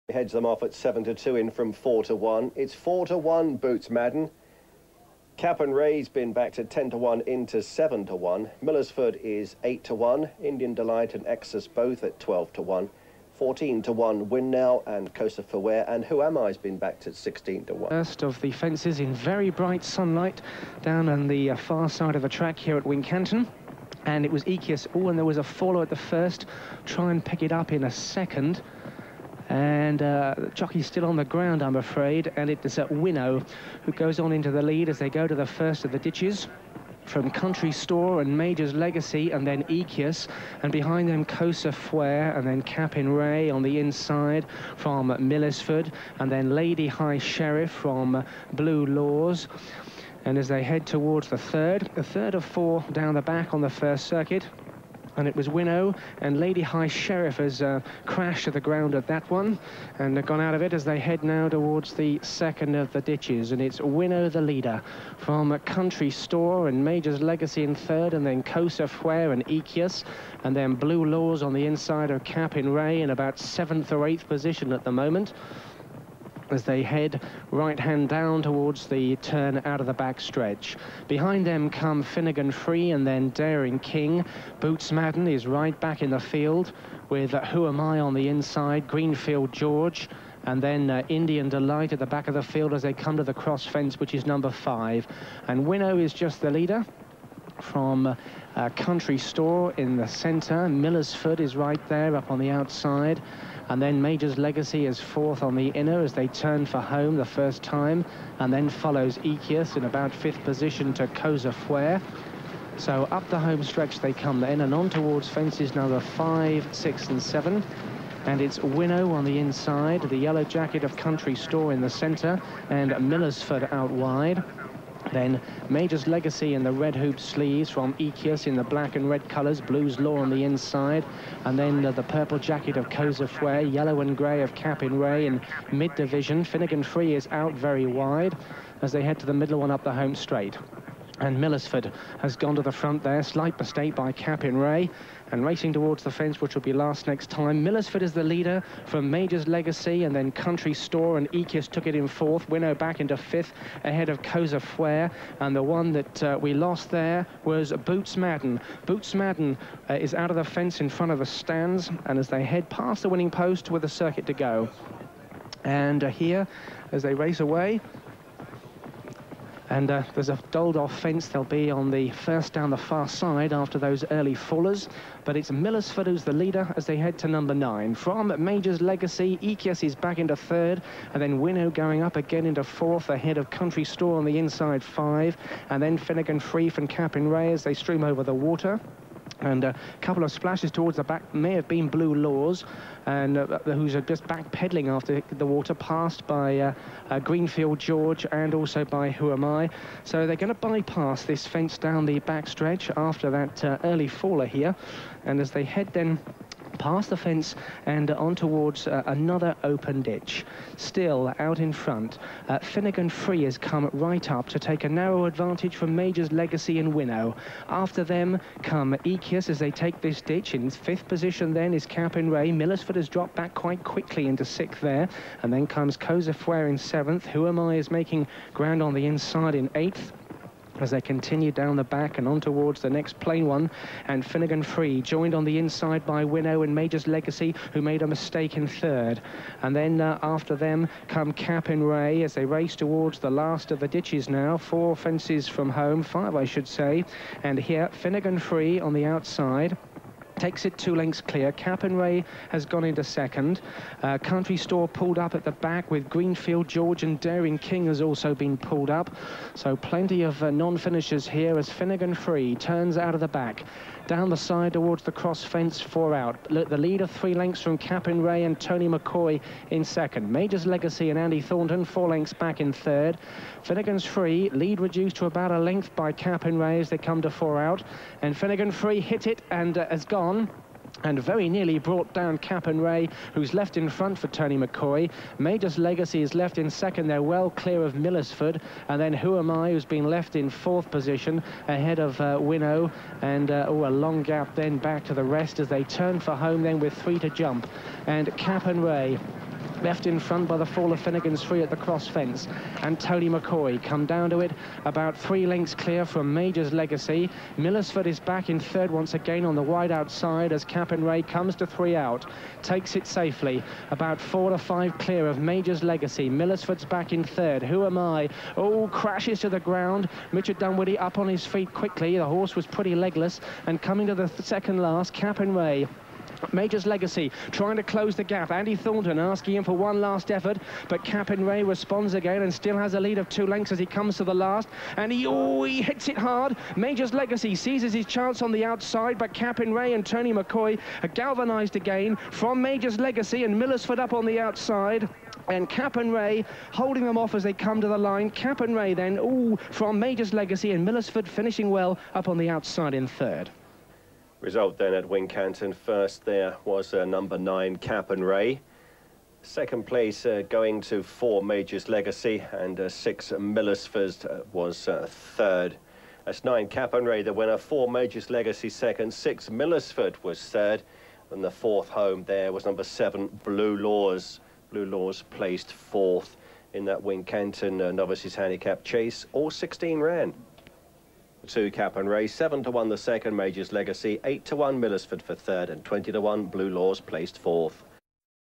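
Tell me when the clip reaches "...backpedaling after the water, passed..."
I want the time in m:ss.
3:14.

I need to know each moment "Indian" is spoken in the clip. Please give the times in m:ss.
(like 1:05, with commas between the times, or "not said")
0:10, 1:31.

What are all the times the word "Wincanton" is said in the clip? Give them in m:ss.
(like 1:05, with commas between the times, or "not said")
0:22, 5:55, 6:17.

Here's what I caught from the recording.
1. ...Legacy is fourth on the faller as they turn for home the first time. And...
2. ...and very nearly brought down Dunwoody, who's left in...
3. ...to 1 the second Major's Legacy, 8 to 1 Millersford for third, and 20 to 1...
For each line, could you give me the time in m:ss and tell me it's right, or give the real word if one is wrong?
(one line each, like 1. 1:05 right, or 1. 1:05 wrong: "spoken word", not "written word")
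1. 1:44 wrong: "inner", not "faller"
2. 4:41 wrong: "Capenwray", not "Dunwoody"
3. 6:22 right.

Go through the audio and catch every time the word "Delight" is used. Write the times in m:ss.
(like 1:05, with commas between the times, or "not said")
0:10, 1:31.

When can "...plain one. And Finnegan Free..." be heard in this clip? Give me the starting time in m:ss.
3:53.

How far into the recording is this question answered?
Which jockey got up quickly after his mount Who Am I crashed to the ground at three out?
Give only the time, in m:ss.
5:20.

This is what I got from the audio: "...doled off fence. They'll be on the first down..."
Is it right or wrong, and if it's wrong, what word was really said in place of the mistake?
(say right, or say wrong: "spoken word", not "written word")
right.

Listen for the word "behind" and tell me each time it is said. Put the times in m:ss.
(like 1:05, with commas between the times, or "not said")
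0:40, 1:21.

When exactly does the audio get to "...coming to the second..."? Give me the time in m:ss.
5:23.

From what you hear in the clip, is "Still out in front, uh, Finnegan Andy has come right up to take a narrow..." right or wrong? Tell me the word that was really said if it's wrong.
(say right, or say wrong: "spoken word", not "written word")
wrong: "Free", not "Andy".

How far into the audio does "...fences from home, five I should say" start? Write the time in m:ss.
4:04.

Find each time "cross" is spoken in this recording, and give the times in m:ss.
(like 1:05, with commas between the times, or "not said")
1:33, 4:25, 5:01.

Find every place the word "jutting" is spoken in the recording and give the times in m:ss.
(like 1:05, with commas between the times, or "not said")
not said.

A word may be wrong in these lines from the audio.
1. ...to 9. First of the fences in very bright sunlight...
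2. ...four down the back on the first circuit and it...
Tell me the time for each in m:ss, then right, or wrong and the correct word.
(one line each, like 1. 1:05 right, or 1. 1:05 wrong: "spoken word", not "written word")
1. 0:17 wrong: "1", not "9"
2. 0:52 right.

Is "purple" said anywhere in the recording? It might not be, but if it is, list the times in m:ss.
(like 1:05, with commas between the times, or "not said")
2:12.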